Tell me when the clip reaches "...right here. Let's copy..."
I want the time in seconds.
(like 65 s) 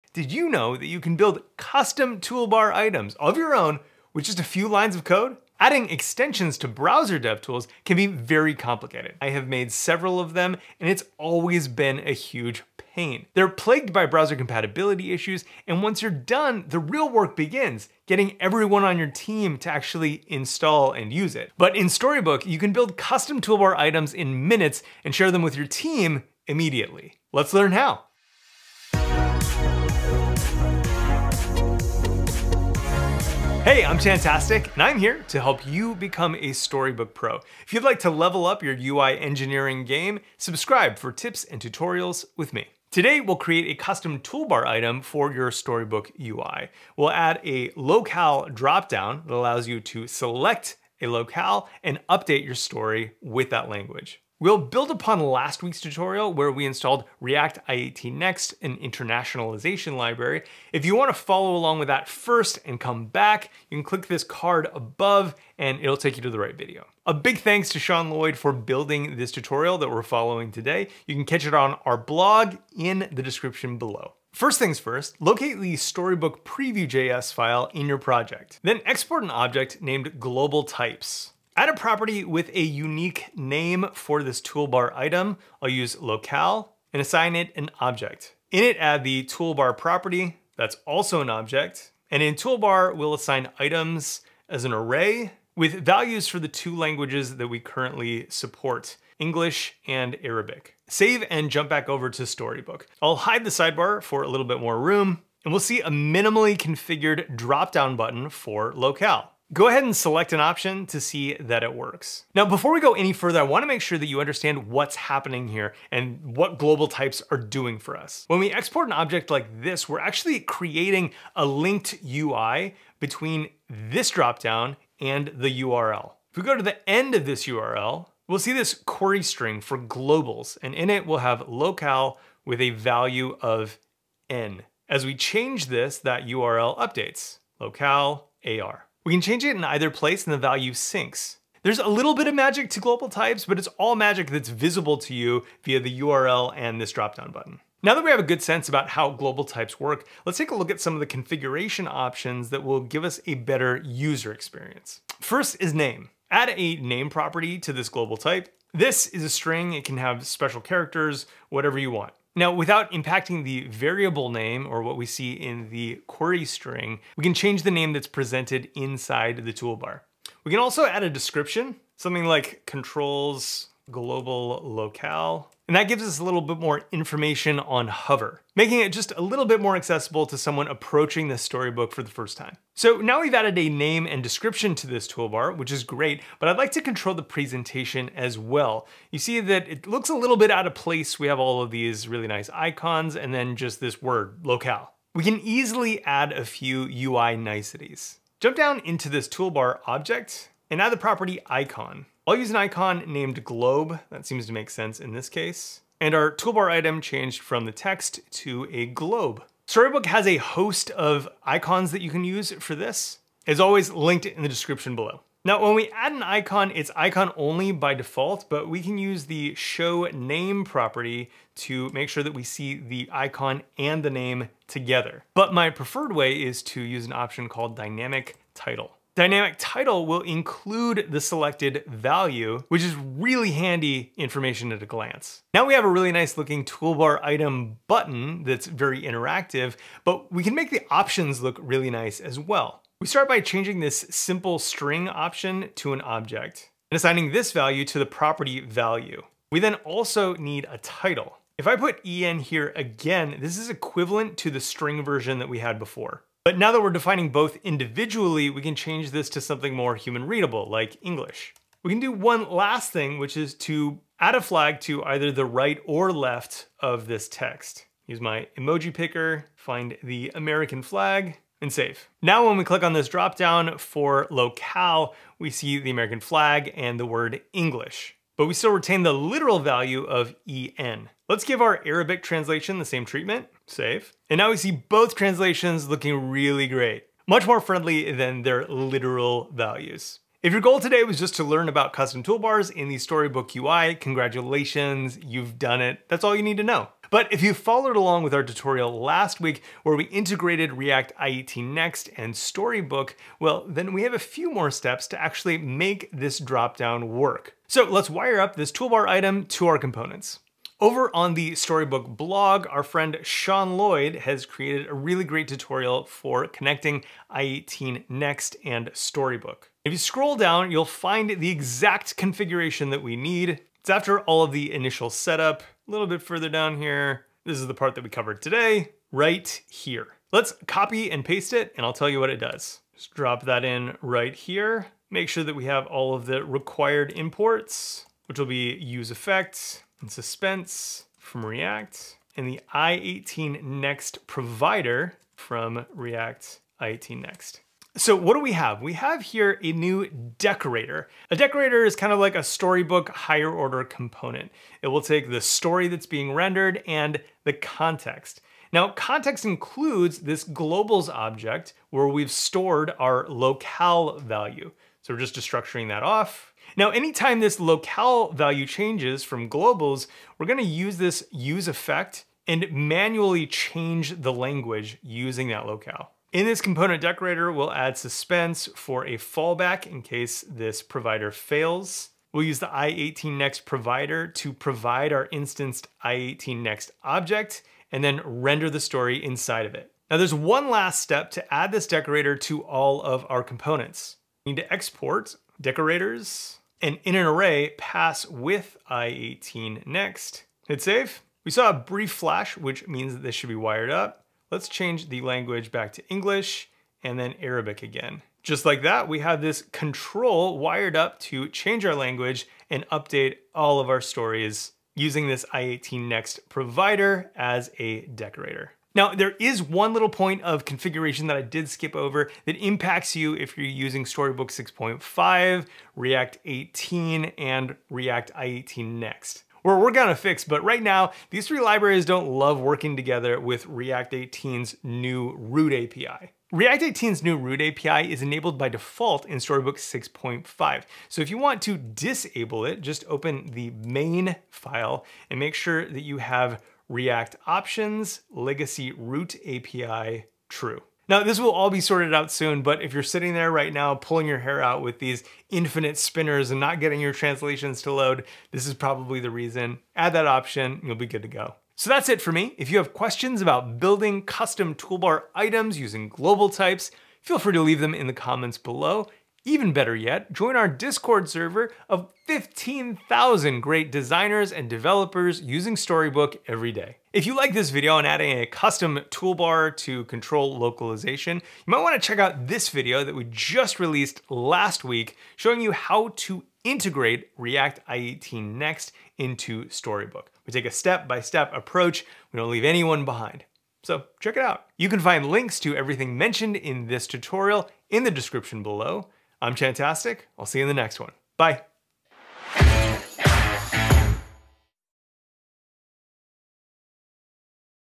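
329 s.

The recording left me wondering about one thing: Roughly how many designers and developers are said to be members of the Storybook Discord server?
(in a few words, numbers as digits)
15,000.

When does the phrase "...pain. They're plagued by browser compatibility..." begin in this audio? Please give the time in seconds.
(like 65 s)
12 s.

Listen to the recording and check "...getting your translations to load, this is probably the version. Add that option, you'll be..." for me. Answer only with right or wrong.
wrong.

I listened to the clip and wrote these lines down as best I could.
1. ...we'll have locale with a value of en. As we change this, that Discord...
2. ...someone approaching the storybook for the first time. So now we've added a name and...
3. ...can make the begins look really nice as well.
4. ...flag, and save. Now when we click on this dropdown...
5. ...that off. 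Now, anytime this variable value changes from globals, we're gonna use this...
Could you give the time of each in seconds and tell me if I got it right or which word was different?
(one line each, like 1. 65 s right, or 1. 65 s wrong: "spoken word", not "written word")
1. 131 s wrong: "URL", not "Discord"
2. 180 s right
3. 240 s wrong: "options", not "begins"
4. 270 s right
5. 365 s wrong: "locale", not "variable".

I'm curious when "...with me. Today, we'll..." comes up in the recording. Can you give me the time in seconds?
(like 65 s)
42 s.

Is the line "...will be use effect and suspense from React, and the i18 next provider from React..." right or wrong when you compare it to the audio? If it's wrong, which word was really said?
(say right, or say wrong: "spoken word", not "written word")
right.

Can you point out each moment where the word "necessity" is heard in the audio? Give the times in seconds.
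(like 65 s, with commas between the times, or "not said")
not said.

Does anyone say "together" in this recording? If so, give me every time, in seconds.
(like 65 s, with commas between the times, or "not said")
224 s, 432 s.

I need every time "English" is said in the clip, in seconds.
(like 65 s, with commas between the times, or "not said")
99 s, 261 s, 277 s, 406 s.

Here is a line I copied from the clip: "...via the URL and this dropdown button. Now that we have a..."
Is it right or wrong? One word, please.
right.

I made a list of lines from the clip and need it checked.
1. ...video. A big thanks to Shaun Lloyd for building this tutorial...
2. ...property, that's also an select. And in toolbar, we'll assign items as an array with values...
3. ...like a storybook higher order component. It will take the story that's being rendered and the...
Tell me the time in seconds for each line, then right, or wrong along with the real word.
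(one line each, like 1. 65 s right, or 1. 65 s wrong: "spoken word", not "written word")
1. 66 s right
2. 89 s wrong: "object", not "select"
3. 352 s right.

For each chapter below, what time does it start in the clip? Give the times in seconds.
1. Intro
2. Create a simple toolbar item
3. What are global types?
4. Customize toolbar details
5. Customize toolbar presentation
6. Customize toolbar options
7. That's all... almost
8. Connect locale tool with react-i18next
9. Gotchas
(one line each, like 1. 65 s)
1. 33 s
2. 74 s
3. 112 s
4. 147 s
5. 182 s
6. 235 s
7. 289 s
8. 307 s
9. 418 s.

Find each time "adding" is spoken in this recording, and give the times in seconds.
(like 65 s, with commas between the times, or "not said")
5 s, 478 s.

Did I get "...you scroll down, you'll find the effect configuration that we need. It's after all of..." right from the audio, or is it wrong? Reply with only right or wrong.
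wrong.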